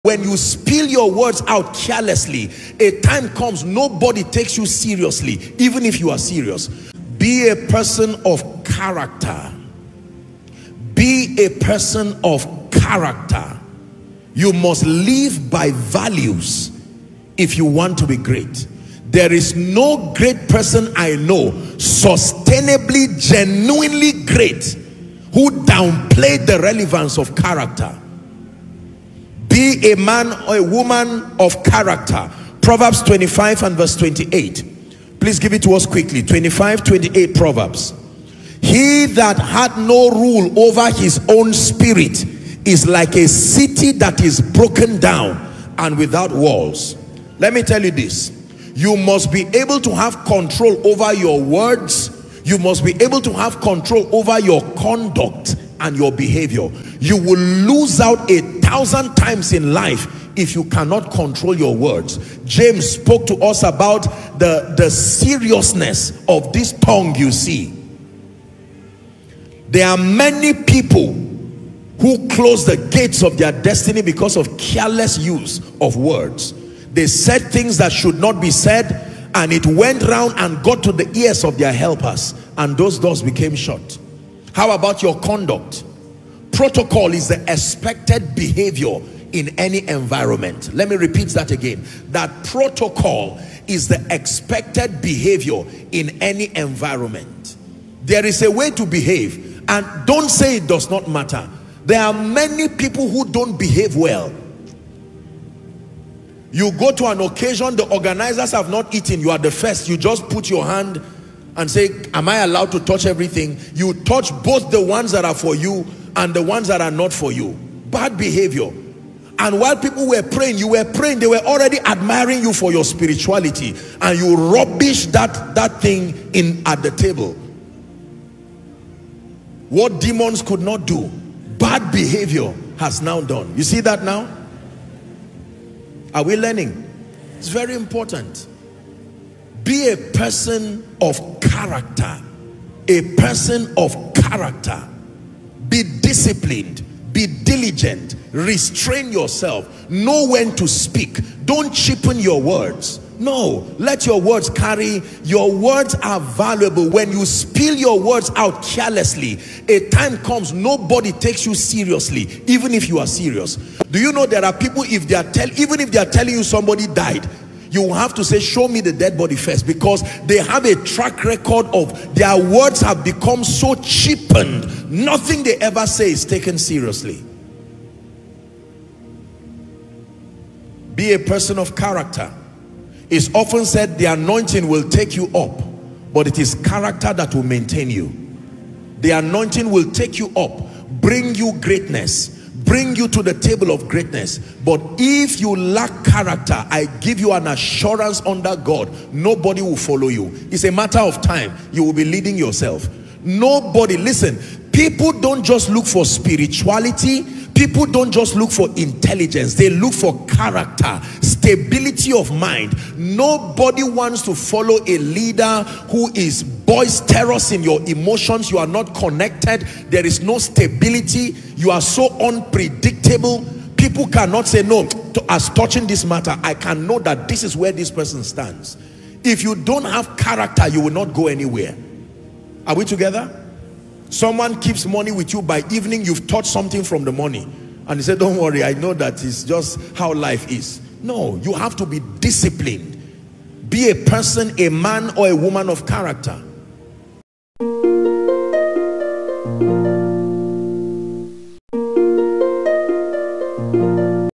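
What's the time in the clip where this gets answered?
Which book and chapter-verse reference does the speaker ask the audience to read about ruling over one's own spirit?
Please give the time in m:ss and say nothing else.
0:32.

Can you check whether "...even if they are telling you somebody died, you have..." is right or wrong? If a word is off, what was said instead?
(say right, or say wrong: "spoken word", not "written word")
right.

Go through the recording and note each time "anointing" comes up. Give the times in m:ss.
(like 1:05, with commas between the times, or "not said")
3:04, 3:09.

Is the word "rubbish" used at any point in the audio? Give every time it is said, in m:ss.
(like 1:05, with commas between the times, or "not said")
2:04.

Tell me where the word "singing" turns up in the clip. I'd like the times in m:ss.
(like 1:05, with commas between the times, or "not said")
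not said.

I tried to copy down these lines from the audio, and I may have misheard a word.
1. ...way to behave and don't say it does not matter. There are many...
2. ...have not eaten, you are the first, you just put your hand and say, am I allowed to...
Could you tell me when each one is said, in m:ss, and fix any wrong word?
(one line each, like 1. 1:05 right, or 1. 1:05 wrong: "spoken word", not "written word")
1. 1:38 right
2. 1:48 right.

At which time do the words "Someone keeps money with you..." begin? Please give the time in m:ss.
3:54.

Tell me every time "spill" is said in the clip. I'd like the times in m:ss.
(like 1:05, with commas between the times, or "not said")
0:00, 2:37.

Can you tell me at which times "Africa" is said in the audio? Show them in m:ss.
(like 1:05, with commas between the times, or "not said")
not said.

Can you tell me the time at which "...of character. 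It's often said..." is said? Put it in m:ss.
3:01.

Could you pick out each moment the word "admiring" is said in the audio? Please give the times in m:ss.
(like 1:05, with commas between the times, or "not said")
2:01.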